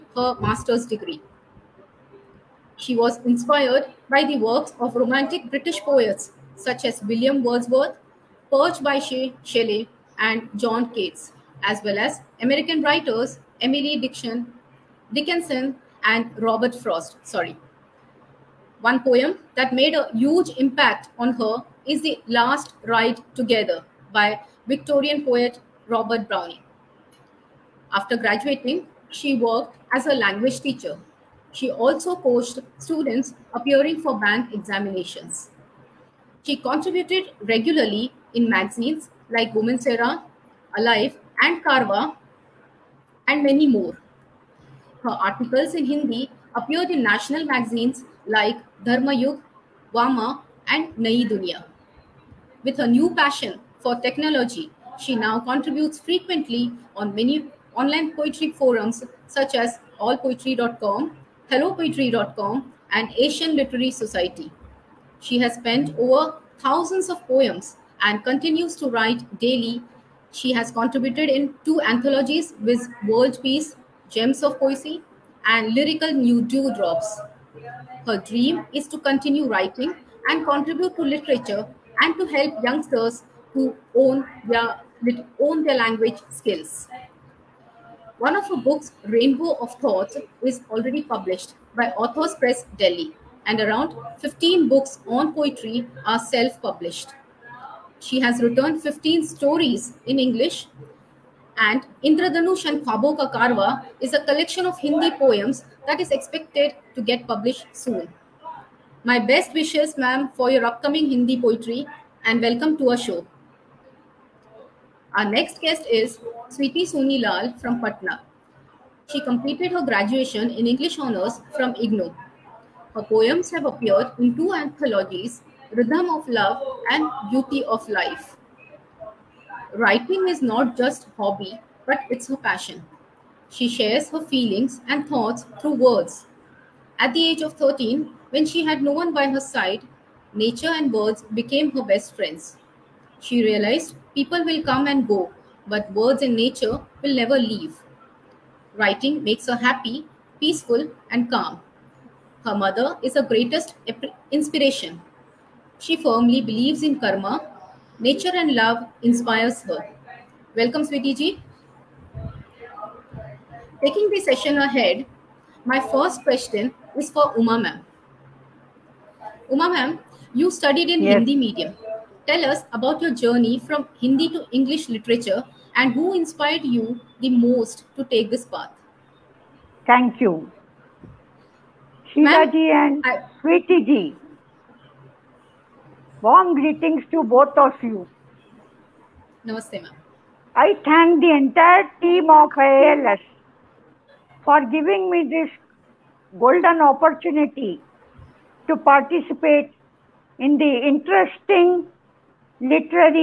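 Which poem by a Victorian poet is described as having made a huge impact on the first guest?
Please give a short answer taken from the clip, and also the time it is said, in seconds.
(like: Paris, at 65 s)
The Last Ride Together, at 22 s.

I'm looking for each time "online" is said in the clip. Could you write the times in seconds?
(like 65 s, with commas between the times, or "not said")
57 s.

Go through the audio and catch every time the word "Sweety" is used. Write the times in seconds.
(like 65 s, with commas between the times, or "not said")
116 s, 160 s.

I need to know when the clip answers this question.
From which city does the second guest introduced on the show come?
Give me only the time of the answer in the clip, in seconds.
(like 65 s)
117 s.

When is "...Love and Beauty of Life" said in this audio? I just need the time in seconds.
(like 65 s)
126 s.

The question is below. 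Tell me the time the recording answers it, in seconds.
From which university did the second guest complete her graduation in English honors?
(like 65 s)
121 s.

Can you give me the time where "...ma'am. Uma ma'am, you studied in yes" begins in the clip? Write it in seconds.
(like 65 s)
167 s.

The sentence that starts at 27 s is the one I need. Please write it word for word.
After graduating she worked as a language teacher.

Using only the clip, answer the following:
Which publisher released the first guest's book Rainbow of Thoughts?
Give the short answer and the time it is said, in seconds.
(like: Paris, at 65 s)
Authors Press Delhi, at 92 s.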